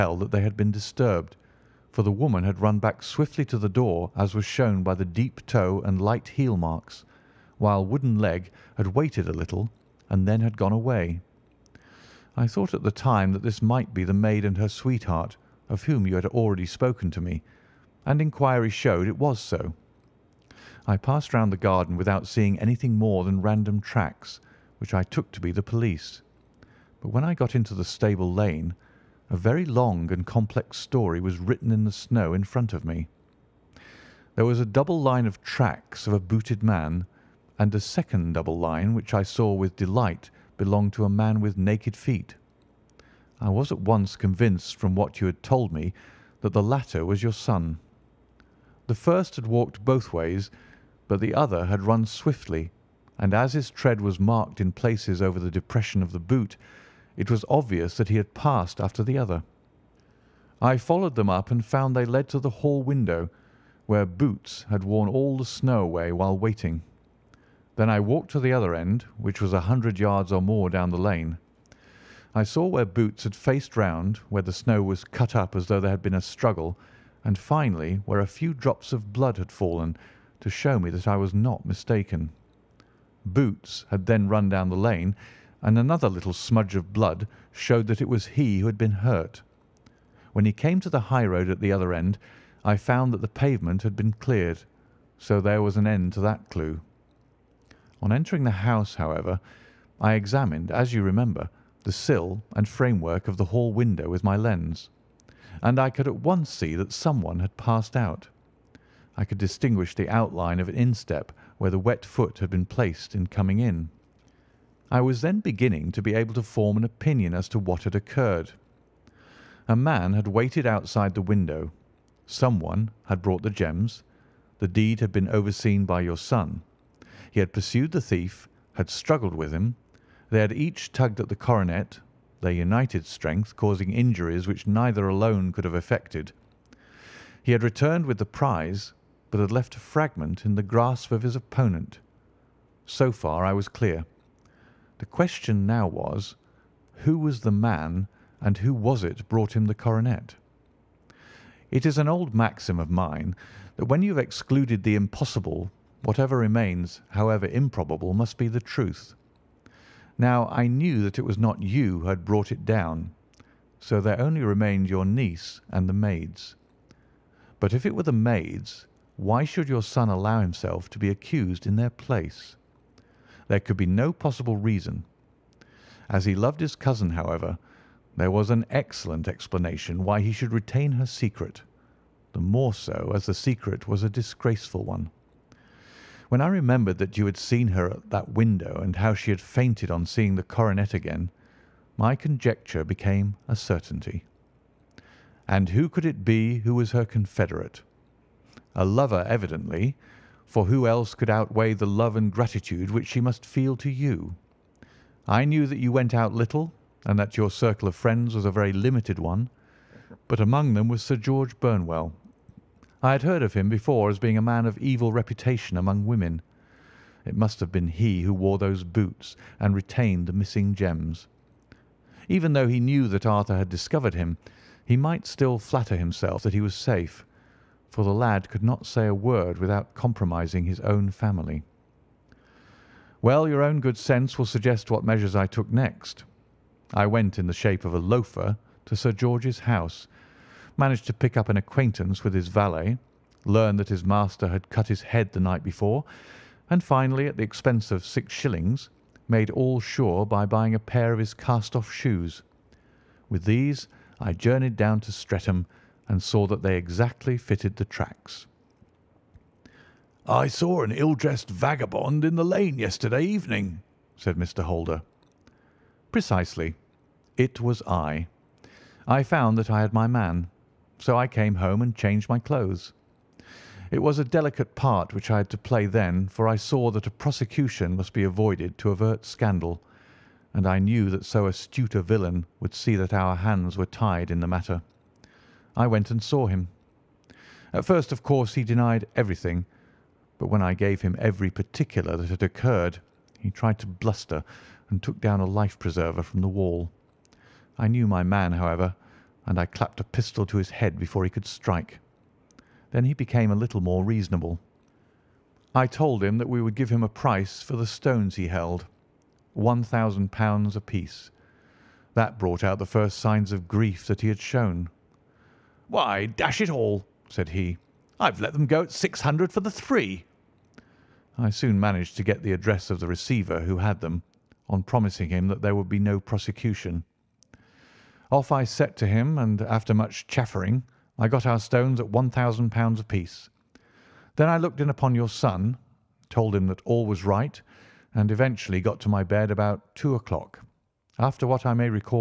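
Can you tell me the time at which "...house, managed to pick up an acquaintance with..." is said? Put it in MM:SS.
03:59.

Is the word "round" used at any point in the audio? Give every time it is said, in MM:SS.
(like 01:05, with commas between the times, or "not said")
00:21, 01:13.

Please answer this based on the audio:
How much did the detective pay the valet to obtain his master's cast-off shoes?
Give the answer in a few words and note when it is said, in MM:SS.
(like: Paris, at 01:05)
6 shillings, at 04:08.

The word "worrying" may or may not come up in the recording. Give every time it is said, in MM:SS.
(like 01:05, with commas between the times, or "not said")
not said.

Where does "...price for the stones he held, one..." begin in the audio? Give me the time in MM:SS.
05:07.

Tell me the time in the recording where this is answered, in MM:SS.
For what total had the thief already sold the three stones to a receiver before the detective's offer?
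05:18.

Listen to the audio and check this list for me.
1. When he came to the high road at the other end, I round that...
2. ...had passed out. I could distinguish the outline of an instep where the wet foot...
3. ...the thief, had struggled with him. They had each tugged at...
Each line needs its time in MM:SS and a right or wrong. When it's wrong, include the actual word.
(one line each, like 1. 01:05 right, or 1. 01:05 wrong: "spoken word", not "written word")
1. 01:30 wrong: "found", not "round"
2. 01:47 right
3. 02:07 right.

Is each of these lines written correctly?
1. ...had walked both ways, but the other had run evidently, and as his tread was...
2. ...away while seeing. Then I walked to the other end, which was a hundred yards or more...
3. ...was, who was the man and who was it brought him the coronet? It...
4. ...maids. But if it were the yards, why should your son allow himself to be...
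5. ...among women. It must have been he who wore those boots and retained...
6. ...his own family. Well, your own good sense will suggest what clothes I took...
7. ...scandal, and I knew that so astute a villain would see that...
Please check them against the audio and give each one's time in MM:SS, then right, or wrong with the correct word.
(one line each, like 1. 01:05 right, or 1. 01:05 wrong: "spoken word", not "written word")
1. 00:49 wrong: "swiftly", not "evidently"
2. 01:05 wrong: "waiting", not "seeing"
3. 02:25 right
4. 02:45 wrong: "maids", not "yards"
5. 03:35 right
6. 03:50 wrong: "measures", not "clothes"
7. 04:39 right.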